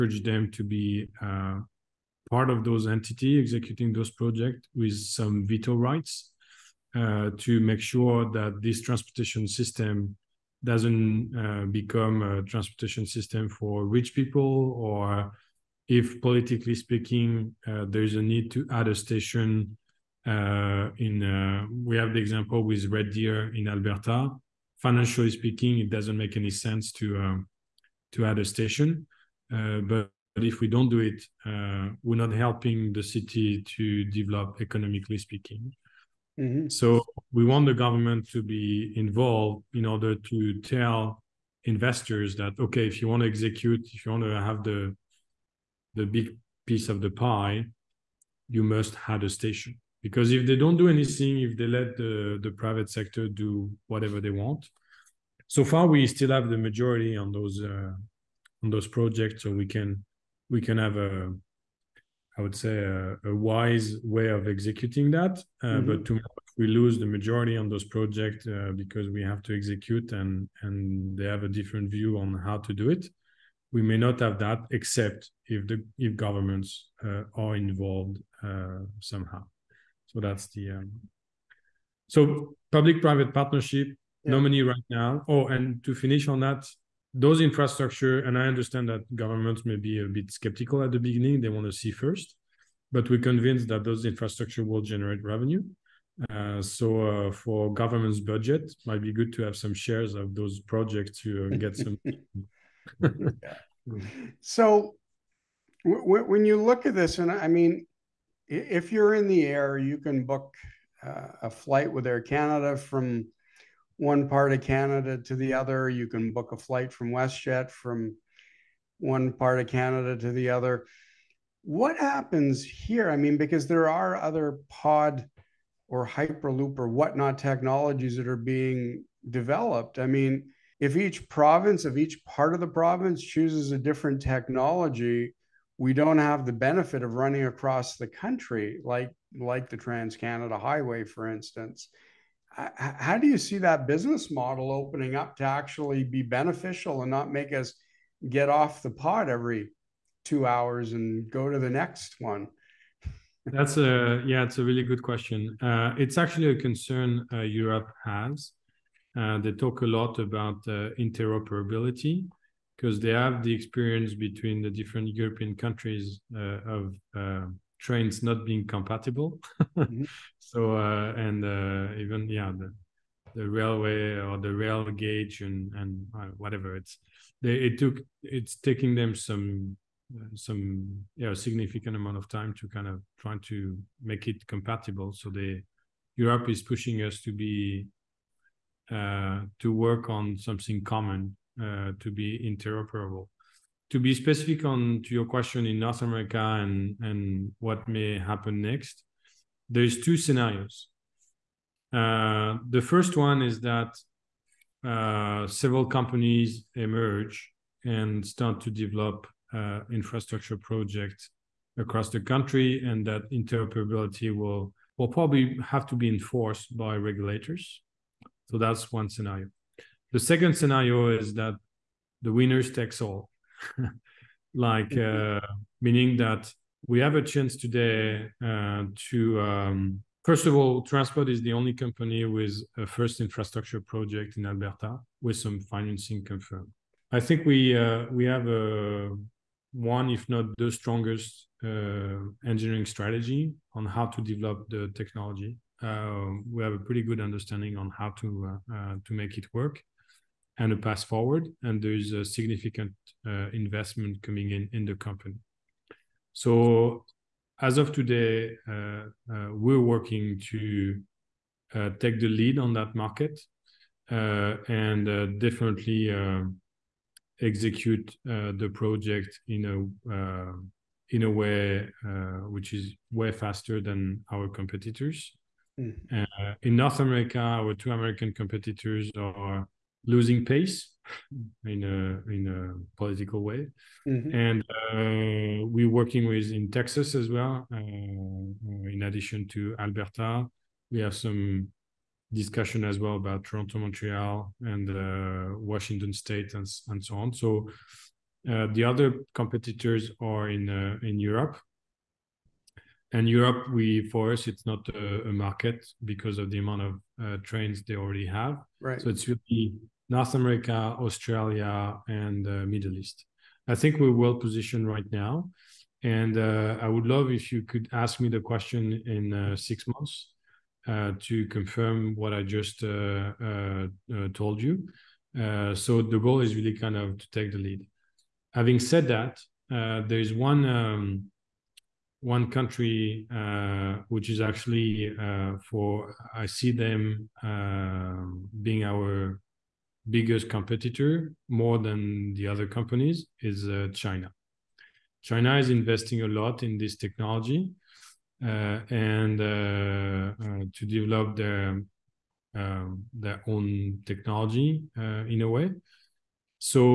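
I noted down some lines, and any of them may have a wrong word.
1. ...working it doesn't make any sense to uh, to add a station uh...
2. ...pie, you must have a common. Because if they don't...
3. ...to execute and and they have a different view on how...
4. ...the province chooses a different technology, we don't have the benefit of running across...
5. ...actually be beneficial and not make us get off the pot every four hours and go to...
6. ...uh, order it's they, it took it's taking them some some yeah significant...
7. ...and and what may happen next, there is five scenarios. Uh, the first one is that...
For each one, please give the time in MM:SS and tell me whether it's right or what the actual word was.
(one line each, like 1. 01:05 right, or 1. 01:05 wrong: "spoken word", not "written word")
1. 00:25 wrong: "speaking", not "working"
2. 00:47 wrong: "station", not "common"
3. 01:09 right
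4. 02:12 right
5. 02:25 wrong: "two", not "four"
6. 02:56 wrong: "whatever", not "order"
7. 03:16 wrong: "two", not "five".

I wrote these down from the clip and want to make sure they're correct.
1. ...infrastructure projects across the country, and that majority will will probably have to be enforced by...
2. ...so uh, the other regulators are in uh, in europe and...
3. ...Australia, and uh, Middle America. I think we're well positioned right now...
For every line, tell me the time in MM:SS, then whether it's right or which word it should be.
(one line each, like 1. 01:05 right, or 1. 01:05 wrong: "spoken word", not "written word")
1. 03:29 wrong: "interoperability", not "majority"
2. 04:57 wrong: "competitors", not "regulators"
3. 05:10 wrong: "East", not "America".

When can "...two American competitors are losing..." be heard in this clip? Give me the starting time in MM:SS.
04:37.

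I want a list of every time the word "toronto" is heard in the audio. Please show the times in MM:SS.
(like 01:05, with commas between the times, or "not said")
04:53.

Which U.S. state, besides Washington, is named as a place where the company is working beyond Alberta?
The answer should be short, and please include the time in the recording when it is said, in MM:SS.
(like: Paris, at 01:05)
Texas, at 04:46.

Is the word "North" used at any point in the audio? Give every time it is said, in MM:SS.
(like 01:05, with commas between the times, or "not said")
03:15, 04:36, 05:10.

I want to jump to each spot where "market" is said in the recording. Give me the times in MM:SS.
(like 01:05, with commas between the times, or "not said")
04:22, 05:05.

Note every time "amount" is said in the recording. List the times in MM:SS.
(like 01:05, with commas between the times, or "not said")
03:01, 05:06.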